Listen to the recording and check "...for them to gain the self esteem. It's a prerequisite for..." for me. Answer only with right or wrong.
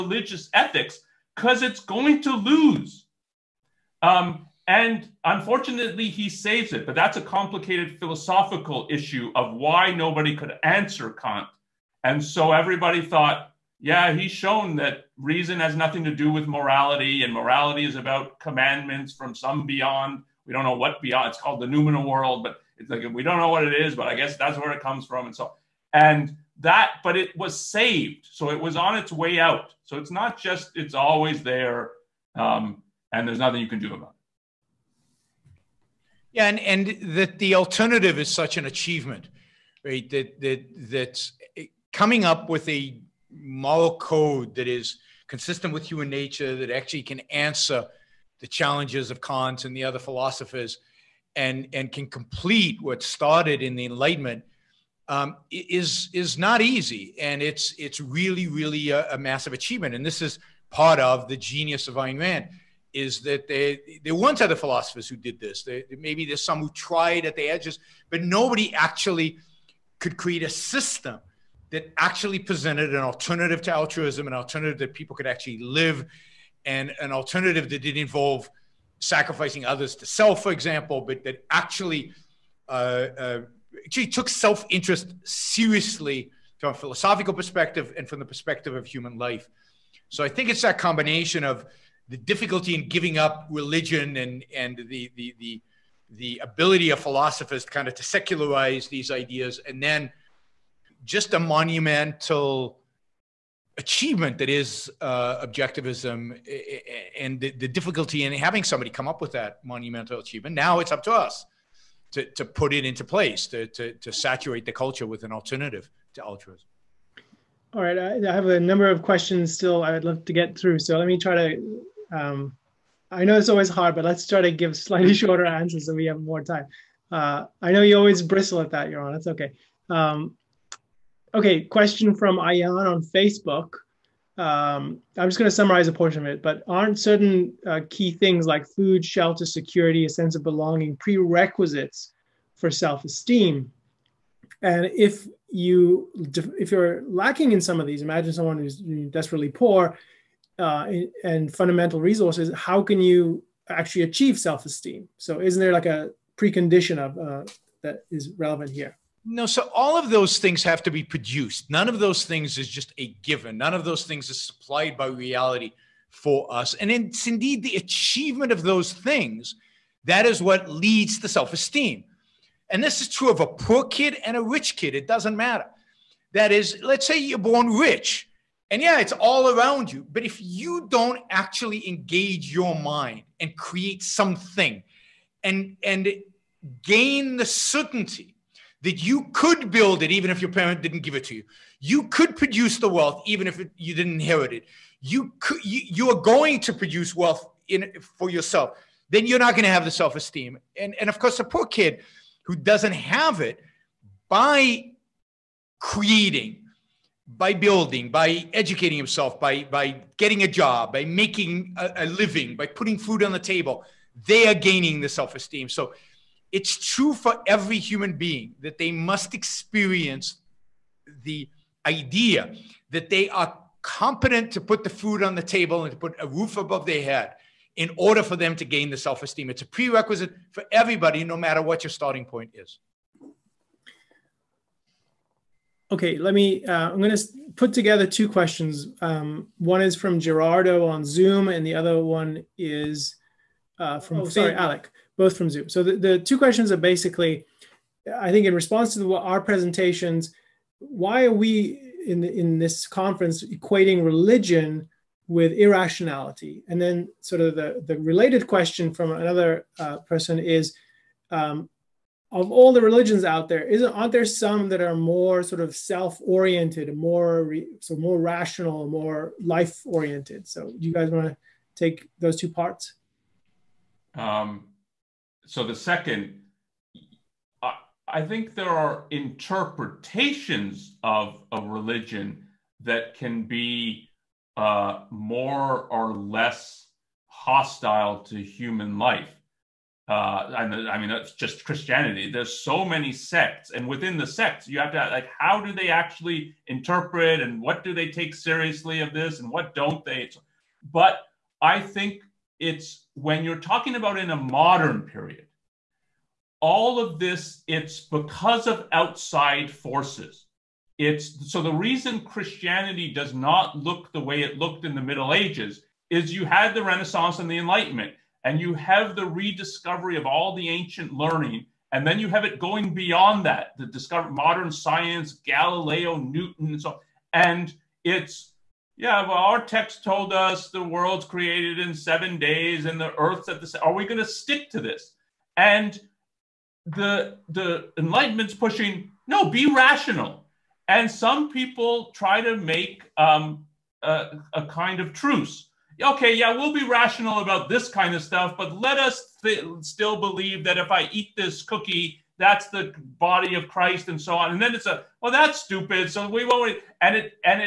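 right.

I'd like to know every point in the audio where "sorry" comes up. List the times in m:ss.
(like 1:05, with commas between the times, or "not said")
4:04.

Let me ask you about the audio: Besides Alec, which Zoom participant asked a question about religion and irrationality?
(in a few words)
Gerardo.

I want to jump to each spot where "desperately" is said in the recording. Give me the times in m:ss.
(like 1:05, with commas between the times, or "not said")
2:29.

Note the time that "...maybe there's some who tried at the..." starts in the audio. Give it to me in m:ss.
1:05.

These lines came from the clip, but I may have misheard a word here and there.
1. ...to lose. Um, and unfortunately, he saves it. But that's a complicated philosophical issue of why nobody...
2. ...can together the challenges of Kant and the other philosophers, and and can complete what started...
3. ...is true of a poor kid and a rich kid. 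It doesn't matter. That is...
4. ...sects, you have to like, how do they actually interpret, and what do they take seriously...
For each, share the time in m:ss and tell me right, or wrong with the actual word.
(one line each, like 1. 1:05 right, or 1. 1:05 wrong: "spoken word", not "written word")
1. 0:02 right
2. 0:47 wrong: "answer", not "together"
3. 2:53 right
4. 4:54 right.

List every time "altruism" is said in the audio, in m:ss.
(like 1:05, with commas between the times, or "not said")
1:13, 1:56.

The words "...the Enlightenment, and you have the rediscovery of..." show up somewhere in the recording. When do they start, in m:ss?
5:17.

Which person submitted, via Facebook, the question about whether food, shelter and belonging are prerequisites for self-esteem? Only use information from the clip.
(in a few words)
Ayan.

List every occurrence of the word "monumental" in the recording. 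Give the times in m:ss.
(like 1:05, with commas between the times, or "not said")
1:41, 1:49.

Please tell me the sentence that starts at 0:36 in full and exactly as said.
Yeah, and and that the alternative is such an achievement, right?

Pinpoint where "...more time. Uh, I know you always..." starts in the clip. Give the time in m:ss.
2:06.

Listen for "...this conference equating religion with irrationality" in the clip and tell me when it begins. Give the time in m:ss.
4:12.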